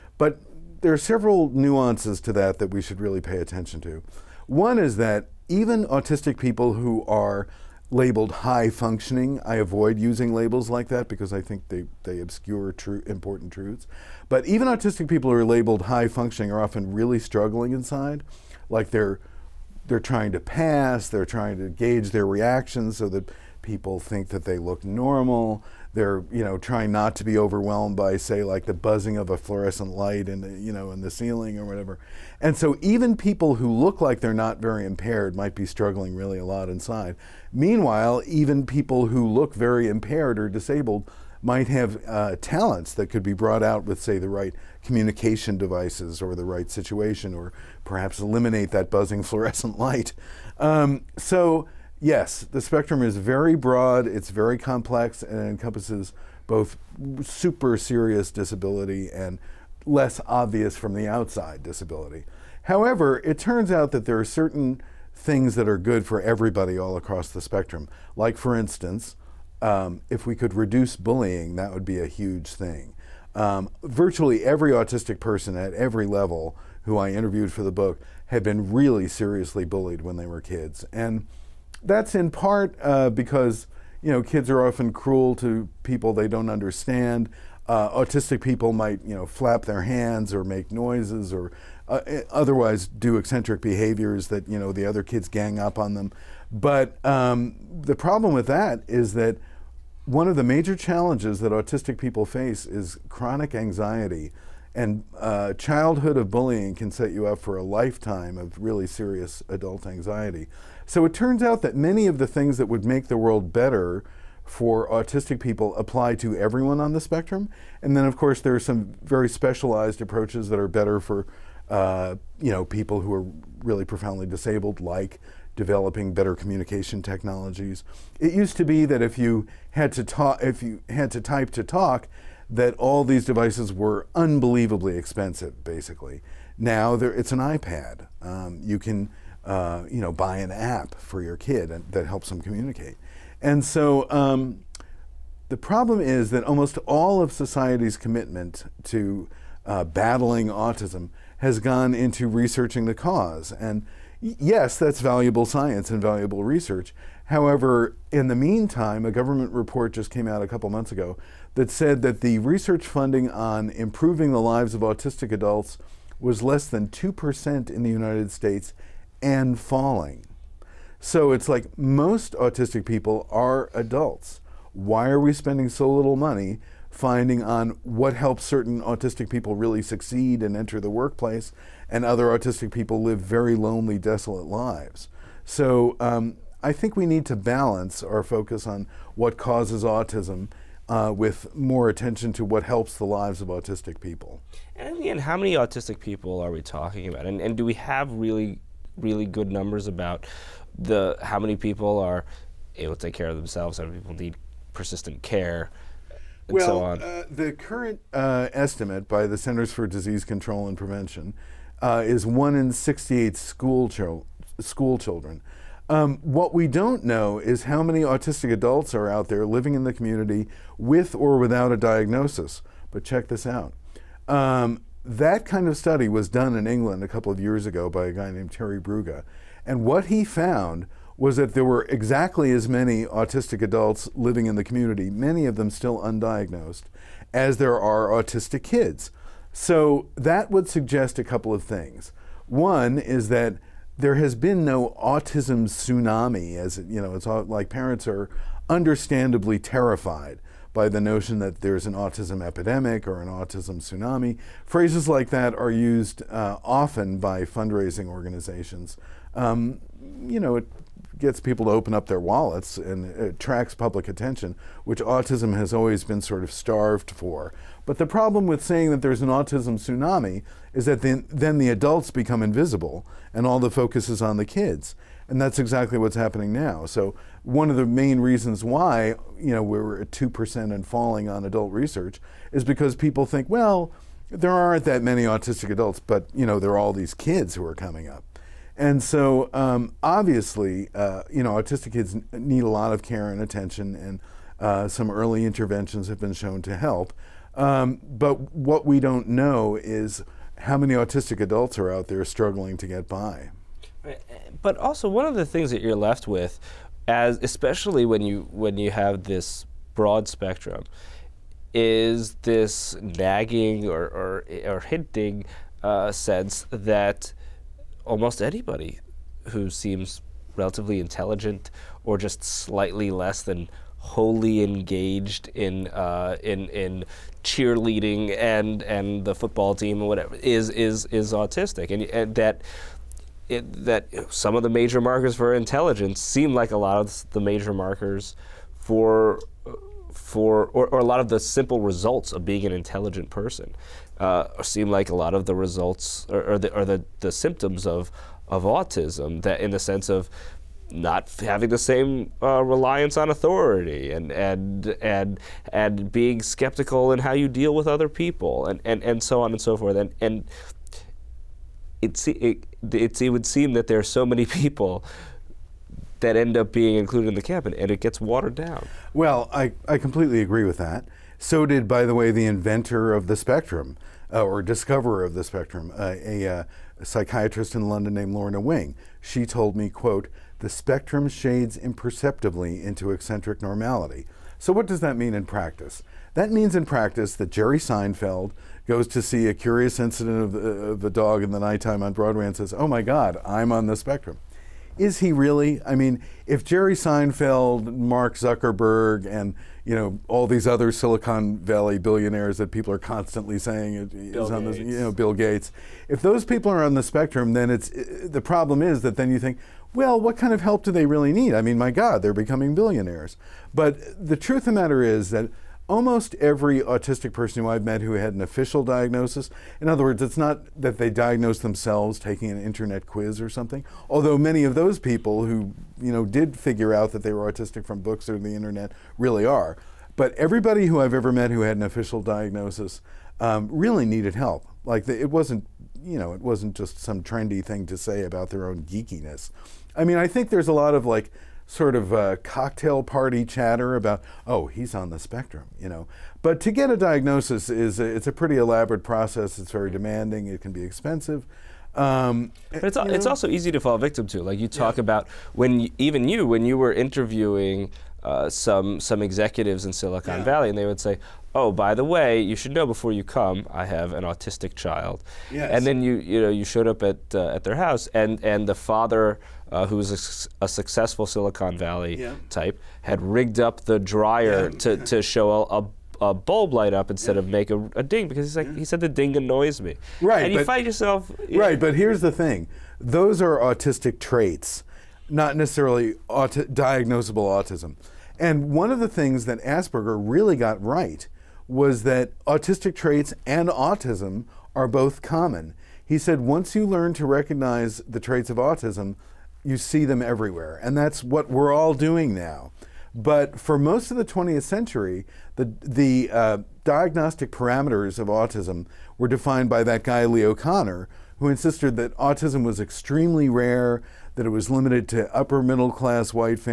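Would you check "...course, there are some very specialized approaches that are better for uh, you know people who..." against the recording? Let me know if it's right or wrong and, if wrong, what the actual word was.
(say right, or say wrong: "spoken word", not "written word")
right.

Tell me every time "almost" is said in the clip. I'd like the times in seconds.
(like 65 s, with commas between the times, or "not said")
146 s, 318 s, 415 s.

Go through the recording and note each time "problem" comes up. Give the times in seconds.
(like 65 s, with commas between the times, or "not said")
97 s, 145 s, 268 s, 408 s.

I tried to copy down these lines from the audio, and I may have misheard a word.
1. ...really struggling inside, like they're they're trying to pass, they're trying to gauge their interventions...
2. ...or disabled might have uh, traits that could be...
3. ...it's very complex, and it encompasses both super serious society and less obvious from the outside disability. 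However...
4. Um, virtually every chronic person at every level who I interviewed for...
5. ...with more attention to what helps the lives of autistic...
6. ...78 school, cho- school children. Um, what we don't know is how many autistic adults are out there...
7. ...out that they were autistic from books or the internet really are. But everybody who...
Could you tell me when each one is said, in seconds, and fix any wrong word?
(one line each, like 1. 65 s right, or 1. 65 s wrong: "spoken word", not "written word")
1. 16 s wrong: "reactions", not "interventions"
2. 40 s wrong: "talents", not "traits"
3. 54 s wrong: "disability", not "society"
4. 73 s wrong: "autistic", not "chronic"
5. 191 s right
6. 212 s wrong: "68", not "78"
7. 426 s right.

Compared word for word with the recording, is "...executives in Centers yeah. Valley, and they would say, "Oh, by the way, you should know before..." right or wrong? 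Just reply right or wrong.
wrong.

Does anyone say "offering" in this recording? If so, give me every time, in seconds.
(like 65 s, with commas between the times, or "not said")
not said.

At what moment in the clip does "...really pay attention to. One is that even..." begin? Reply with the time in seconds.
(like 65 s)
2 s.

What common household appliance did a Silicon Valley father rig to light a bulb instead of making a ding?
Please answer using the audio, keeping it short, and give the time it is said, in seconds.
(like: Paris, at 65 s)
dryer, at 473 s.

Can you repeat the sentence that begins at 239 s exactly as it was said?
So that would suggest a couple of things.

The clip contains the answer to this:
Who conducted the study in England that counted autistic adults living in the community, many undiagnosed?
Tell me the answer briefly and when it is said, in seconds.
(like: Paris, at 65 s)
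Terry Brugha, at 228 s.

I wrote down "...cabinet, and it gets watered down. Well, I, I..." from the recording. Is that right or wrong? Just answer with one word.
right.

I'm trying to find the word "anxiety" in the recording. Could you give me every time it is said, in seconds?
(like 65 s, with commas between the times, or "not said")
103 s, 109 s.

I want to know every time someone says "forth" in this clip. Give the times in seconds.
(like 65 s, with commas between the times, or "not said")
359 s.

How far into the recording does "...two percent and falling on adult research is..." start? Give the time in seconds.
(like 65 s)
280 s.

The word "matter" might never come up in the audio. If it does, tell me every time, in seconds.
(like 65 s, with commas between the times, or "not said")
414 s.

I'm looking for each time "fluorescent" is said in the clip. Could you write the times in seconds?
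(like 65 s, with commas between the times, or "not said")
29 s, 49 s.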